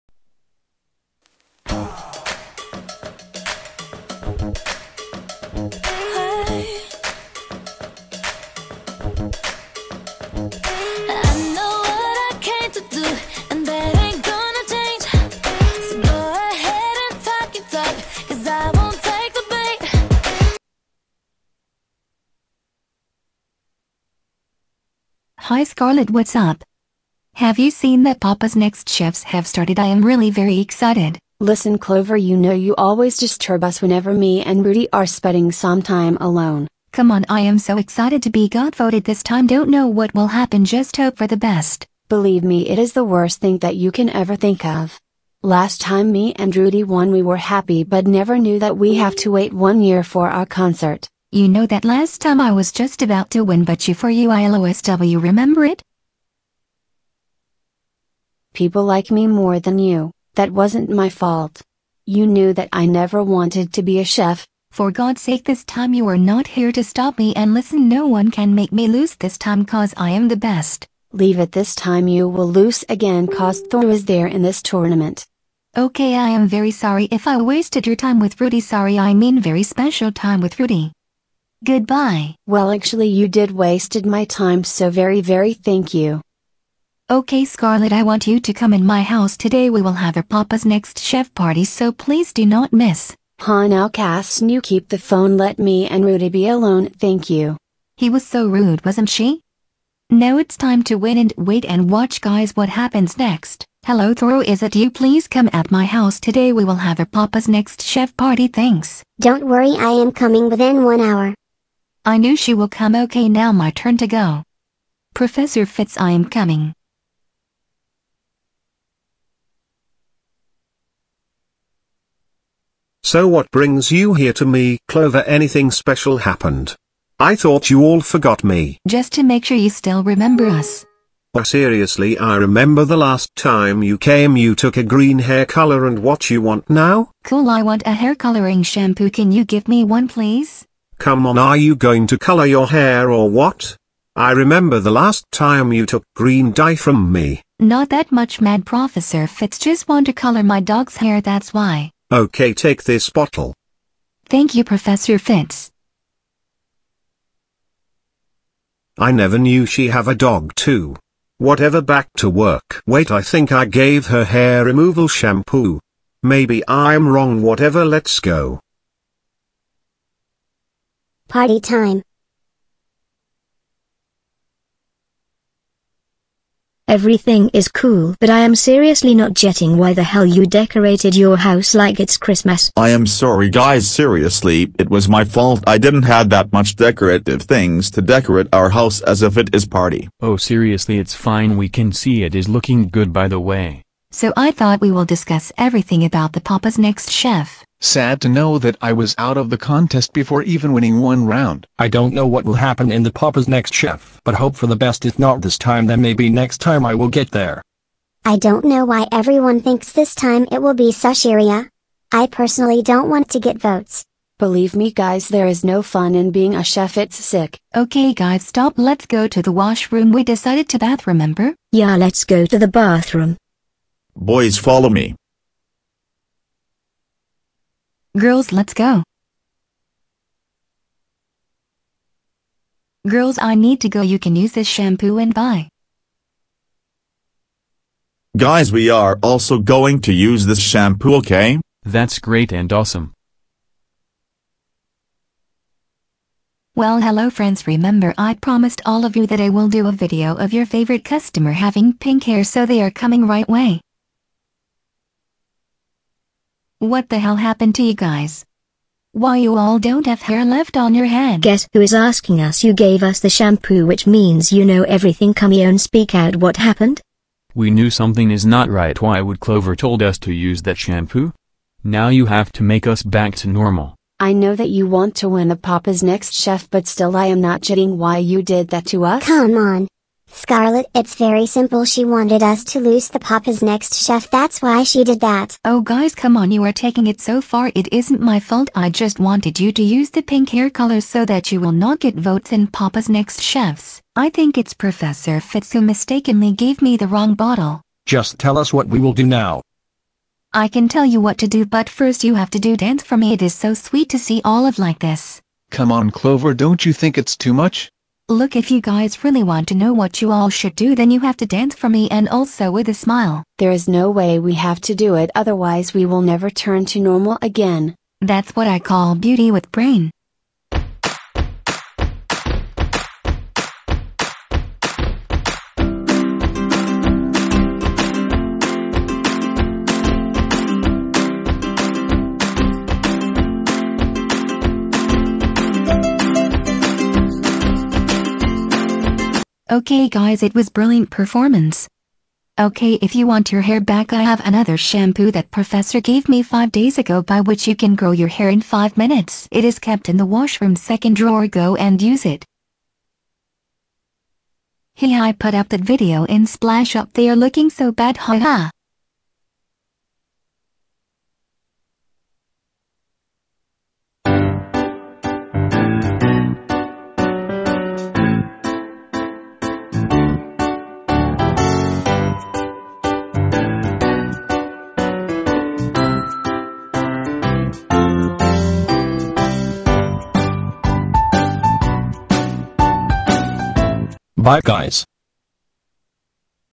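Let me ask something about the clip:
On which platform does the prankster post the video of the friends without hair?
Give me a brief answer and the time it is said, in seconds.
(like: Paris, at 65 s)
Splash Up, at 356 s.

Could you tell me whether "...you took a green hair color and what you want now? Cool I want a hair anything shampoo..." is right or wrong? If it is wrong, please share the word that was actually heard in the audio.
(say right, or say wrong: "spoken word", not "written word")
wrong: "coloring", not "anything".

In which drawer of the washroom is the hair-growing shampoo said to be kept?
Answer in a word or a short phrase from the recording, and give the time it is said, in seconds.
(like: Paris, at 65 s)
Second drawer, at 350 s.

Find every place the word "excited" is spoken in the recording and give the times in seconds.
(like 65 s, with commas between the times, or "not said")
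30 s, 37 s.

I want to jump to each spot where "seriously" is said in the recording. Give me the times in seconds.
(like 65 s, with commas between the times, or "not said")
131 s, 178 s, 183 s, 190 s.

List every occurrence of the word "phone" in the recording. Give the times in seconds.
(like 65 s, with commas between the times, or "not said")
94 s.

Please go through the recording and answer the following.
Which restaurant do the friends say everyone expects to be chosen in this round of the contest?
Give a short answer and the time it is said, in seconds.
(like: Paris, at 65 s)
Sushiria, at 210 s.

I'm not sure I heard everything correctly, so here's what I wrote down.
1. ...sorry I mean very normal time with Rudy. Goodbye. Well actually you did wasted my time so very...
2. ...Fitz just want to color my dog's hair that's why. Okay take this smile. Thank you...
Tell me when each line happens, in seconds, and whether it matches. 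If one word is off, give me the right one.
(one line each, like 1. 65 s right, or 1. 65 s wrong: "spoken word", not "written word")
1. 78 s wrong: "special", not "normal"
2. 149 s wrong: "bottle", not "smile".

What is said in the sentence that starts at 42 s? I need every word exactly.
Believe me it is the worst thing that you can ever think of.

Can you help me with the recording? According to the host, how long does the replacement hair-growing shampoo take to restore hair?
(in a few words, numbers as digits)
5 minutes.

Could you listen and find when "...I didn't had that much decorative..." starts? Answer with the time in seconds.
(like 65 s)
185 s.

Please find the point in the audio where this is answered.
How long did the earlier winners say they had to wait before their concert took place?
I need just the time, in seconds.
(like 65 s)
49 s.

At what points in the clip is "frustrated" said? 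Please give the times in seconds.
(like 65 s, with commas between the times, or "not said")
not said.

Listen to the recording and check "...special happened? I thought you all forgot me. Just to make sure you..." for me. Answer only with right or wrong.
right.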